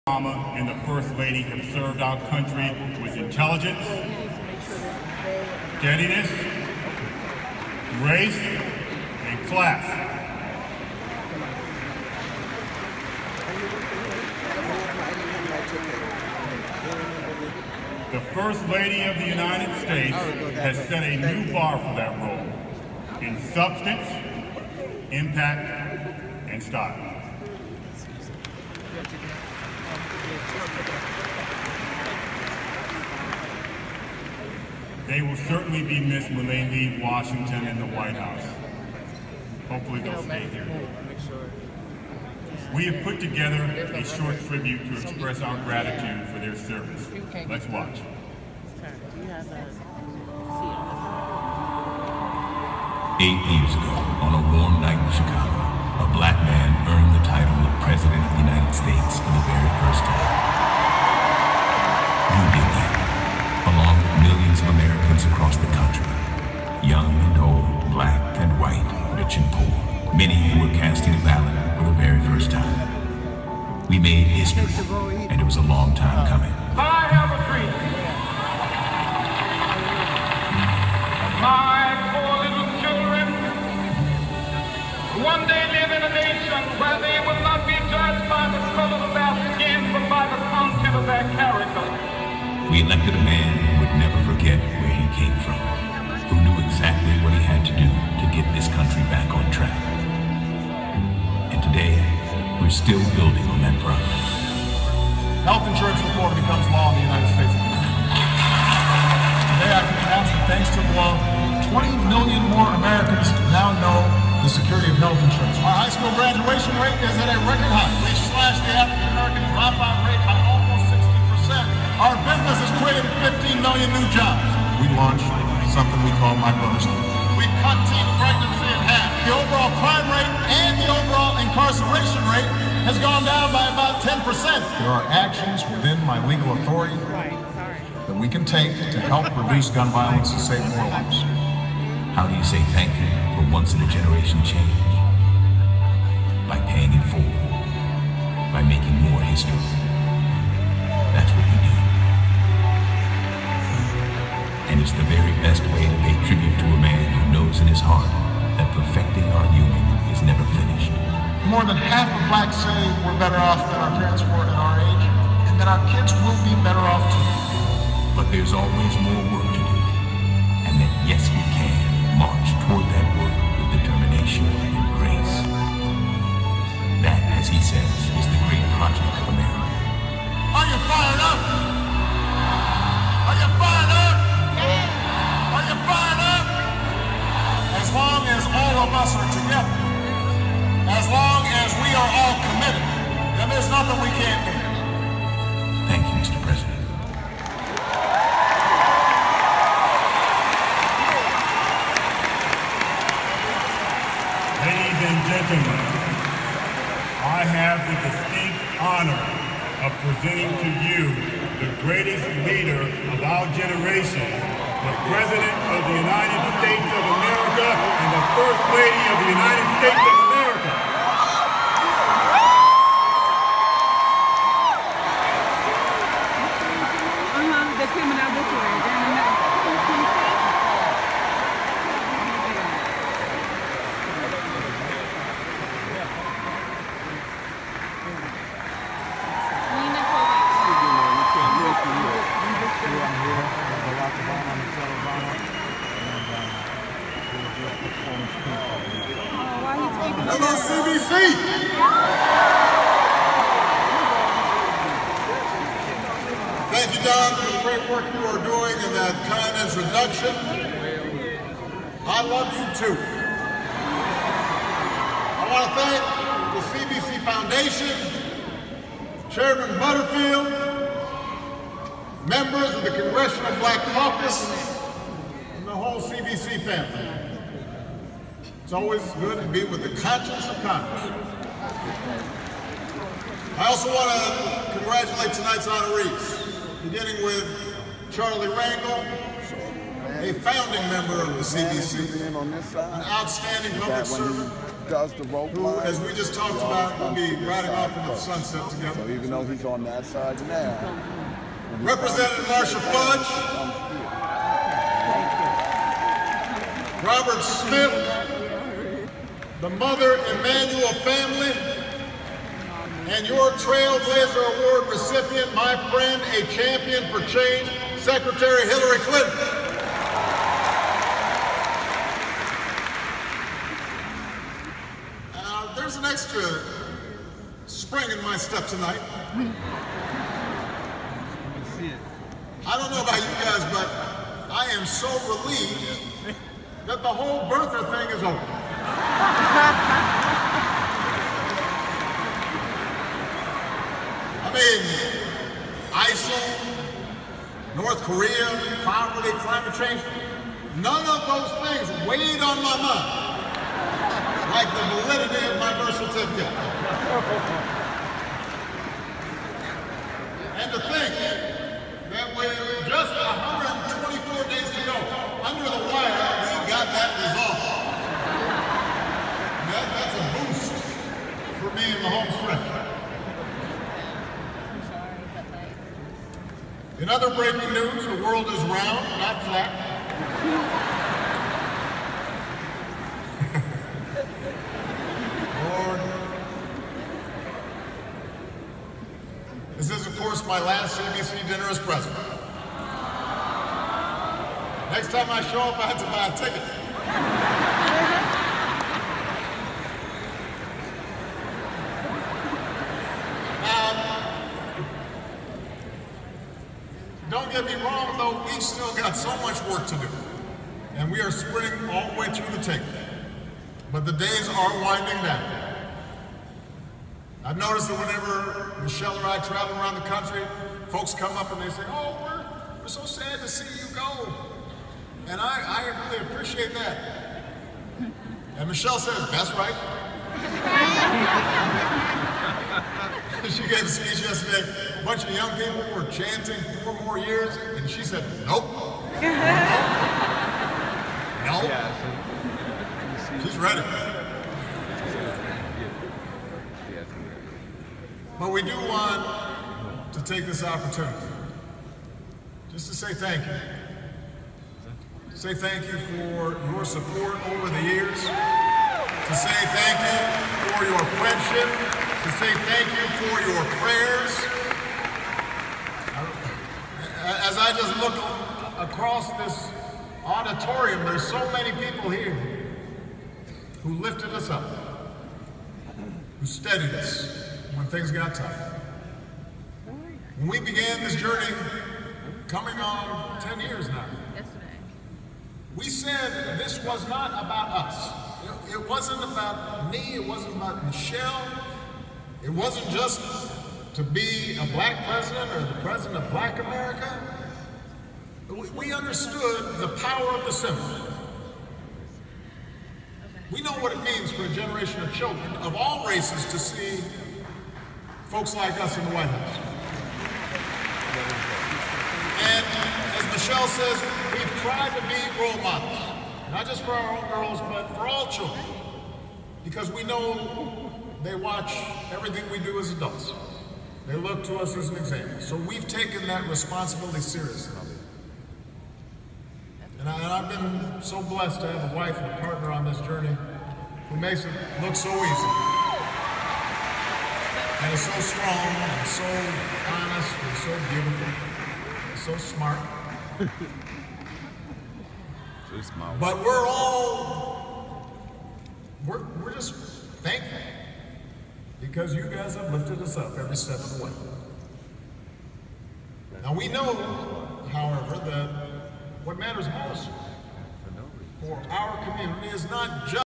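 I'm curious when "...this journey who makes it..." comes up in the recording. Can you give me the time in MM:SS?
08:52.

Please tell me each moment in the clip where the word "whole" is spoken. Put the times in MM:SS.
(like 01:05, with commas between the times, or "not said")
04:35, 05:37.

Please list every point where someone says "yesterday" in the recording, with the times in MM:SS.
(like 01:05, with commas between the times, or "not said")
07:14, 08:04.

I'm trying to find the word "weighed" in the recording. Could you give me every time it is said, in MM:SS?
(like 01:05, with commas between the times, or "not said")
05:52.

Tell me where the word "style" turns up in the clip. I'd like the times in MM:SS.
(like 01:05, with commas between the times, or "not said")
00:26.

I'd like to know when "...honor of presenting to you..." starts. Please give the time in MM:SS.
03:28.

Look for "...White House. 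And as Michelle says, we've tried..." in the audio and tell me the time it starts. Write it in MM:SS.
08:29.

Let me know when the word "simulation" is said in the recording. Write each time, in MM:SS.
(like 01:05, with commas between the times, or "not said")
not said.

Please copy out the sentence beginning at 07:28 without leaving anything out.
But we do want to take this opportunity just to say thank you.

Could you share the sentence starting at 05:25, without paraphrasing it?
Uh, there's an extra spring in my step tonight.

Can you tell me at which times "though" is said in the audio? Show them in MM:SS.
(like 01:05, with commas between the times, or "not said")
04:59, 06:48.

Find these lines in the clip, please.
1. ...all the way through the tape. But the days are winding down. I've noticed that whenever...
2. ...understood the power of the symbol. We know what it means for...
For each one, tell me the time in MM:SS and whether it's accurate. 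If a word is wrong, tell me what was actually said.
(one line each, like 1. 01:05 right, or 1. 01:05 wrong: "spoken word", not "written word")
1. 06:51 right
2. 08:18 right.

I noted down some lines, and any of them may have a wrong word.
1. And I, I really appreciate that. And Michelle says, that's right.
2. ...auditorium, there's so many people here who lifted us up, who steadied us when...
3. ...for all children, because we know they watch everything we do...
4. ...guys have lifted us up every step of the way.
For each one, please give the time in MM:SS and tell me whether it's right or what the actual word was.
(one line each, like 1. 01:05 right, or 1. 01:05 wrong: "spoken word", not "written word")
1. 07:05 right
2. 07:50 right
3. 08:37 right
4. 09:12 right.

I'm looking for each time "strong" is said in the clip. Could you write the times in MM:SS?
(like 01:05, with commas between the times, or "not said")
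08:58.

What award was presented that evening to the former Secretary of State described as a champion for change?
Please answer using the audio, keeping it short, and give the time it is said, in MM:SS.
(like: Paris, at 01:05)
Trailblazer Award, at 05:13.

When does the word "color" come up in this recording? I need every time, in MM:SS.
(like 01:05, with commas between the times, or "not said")
01:28.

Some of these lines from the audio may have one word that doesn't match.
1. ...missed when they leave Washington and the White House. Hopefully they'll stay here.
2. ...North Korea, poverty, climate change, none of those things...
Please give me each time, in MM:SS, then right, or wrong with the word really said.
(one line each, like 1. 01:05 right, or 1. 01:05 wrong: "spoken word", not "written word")
1. 00:35 right
2. 05:47 right.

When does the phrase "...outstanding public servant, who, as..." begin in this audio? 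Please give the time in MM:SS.
04:53.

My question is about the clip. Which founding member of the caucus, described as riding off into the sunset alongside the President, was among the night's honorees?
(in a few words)
Charlie Rangel.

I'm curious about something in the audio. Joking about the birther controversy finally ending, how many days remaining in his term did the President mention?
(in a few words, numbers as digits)
124.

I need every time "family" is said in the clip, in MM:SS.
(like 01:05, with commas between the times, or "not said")
04:36, 05:11.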